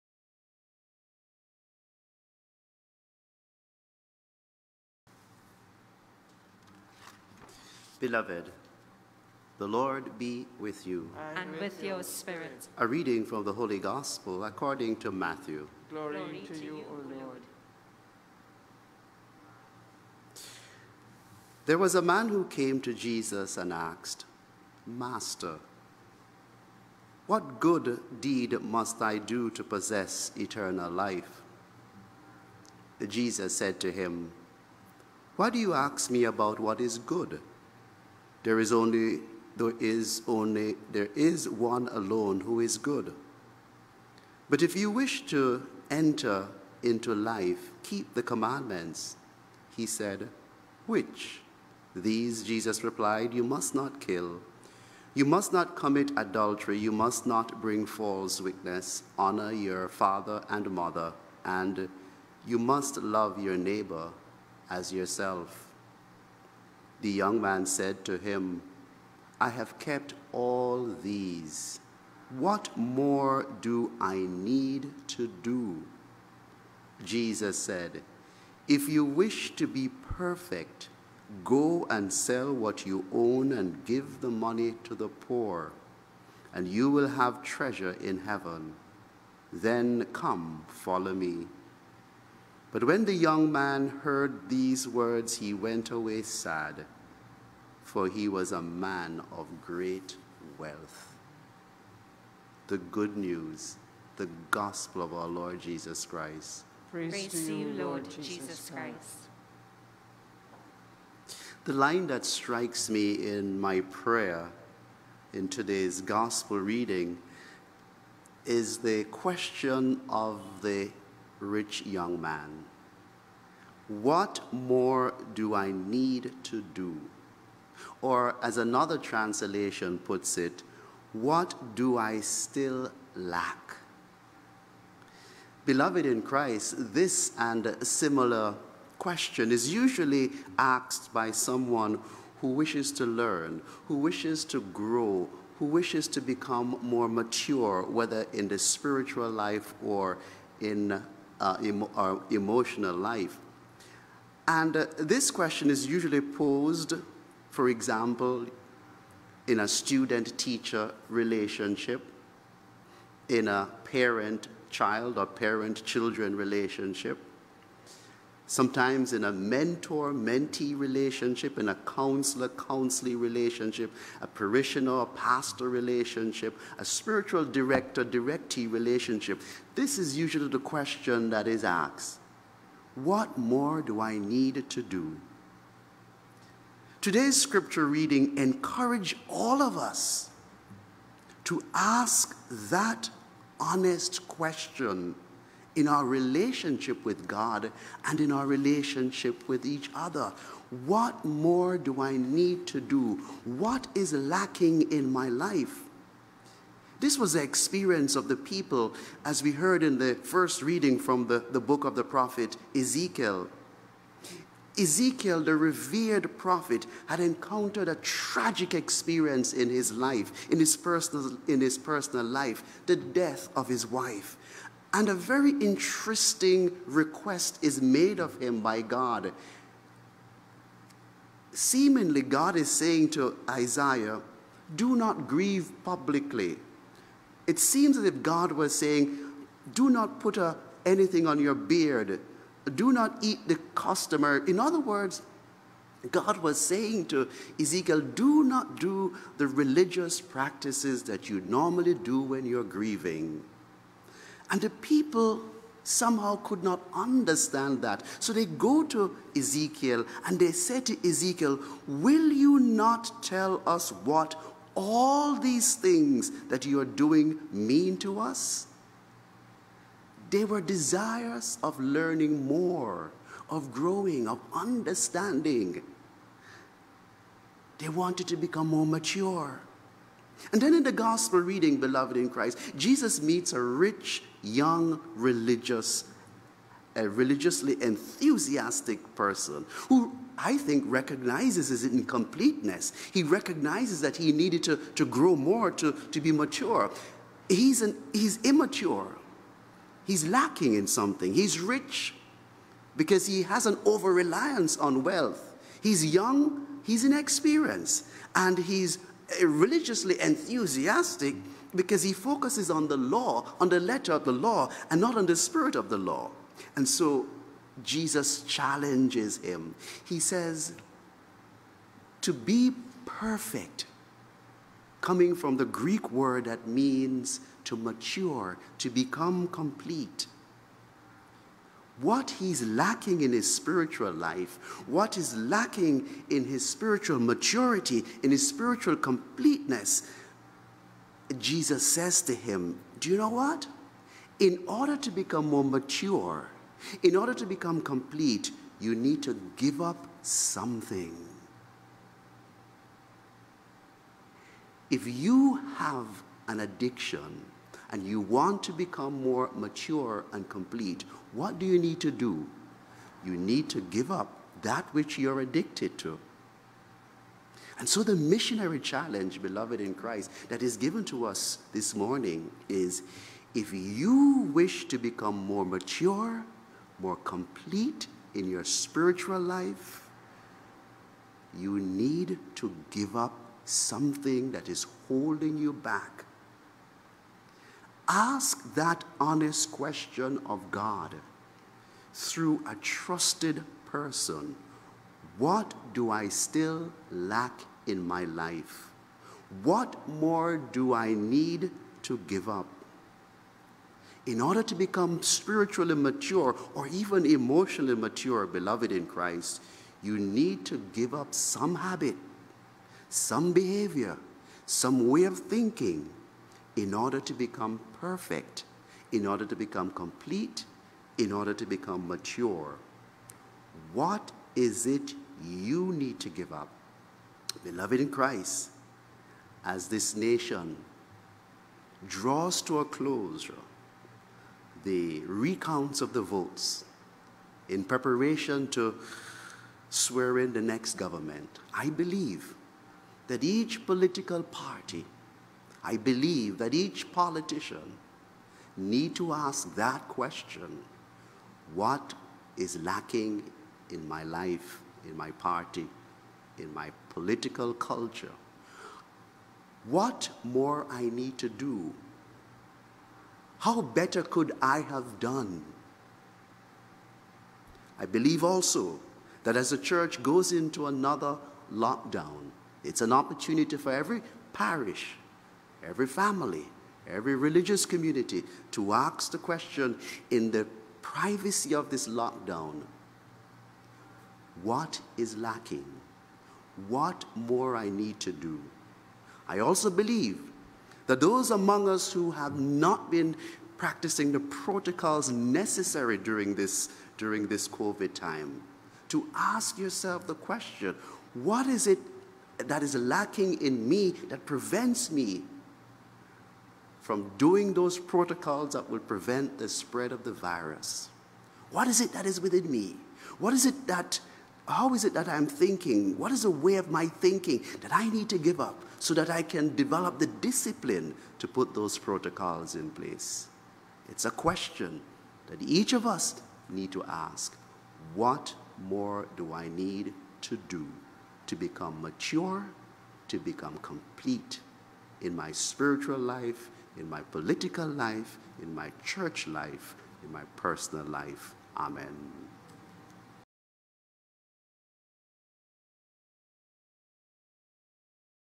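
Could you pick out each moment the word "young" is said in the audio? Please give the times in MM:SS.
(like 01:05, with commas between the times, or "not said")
01:07, 01:33, 02:01, 04:44, 05:06.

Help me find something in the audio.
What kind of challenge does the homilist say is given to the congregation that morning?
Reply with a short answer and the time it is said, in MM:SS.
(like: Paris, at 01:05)
missionary challenge, at 06:08.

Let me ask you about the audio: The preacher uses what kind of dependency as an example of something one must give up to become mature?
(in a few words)
an addiction.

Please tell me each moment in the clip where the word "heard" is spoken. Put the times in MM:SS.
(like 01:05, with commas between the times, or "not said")
01:34, 03:29.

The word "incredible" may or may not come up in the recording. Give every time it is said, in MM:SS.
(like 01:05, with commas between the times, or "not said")
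not said.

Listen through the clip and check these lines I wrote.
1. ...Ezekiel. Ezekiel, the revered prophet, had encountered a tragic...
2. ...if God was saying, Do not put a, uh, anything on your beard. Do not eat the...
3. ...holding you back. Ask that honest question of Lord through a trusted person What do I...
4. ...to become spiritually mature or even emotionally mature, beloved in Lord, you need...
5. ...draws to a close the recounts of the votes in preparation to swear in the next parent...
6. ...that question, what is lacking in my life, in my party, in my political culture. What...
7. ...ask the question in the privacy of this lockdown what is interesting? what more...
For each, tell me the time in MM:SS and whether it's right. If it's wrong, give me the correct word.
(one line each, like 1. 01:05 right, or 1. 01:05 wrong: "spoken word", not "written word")
1. 03:32 right
2. 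03:58 right
3. 06:25 wrong: "God", not "Lord"
4. 06:44 wrong: "Christ", not "Lord"
5. 07:12 wrong: "government", not "parent"
6. 07:29 right
7. 07:58 wrong: "lacking", not "interesting".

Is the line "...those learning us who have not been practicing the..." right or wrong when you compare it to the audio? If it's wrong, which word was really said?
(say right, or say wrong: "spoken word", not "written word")
wrong: "among", not "learning".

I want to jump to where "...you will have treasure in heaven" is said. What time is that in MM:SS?
01:26.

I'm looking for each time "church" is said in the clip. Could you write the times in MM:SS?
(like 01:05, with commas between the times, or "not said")
07:49, 08:59.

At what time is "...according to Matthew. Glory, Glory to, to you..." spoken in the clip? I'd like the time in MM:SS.
00:14.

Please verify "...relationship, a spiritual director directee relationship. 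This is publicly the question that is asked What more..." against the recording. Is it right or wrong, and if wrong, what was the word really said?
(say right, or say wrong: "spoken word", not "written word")
wrong: "usually", not "publicly".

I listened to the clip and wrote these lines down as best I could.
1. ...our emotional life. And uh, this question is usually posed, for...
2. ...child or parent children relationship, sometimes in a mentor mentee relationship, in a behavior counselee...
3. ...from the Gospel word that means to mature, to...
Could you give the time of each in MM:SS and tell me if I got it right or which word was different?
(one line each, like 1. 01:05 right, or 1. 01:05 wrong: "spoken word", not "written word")
1. 02:31 right
2. 02:44 wrong: "counselor", not "behavior"
3. 05:25 wrong: "Greek", not "Gospel".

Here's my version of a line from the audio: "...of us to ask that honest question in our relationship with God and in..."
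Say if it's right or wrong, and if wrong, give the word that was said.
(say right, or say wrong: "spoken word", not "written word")
right.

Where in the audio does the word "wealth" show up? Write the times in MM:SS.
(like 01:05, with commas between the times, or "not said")
01:40, 05:05.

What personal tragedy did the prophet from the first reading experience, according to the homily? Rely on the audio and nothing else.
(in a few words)
the death of his wife.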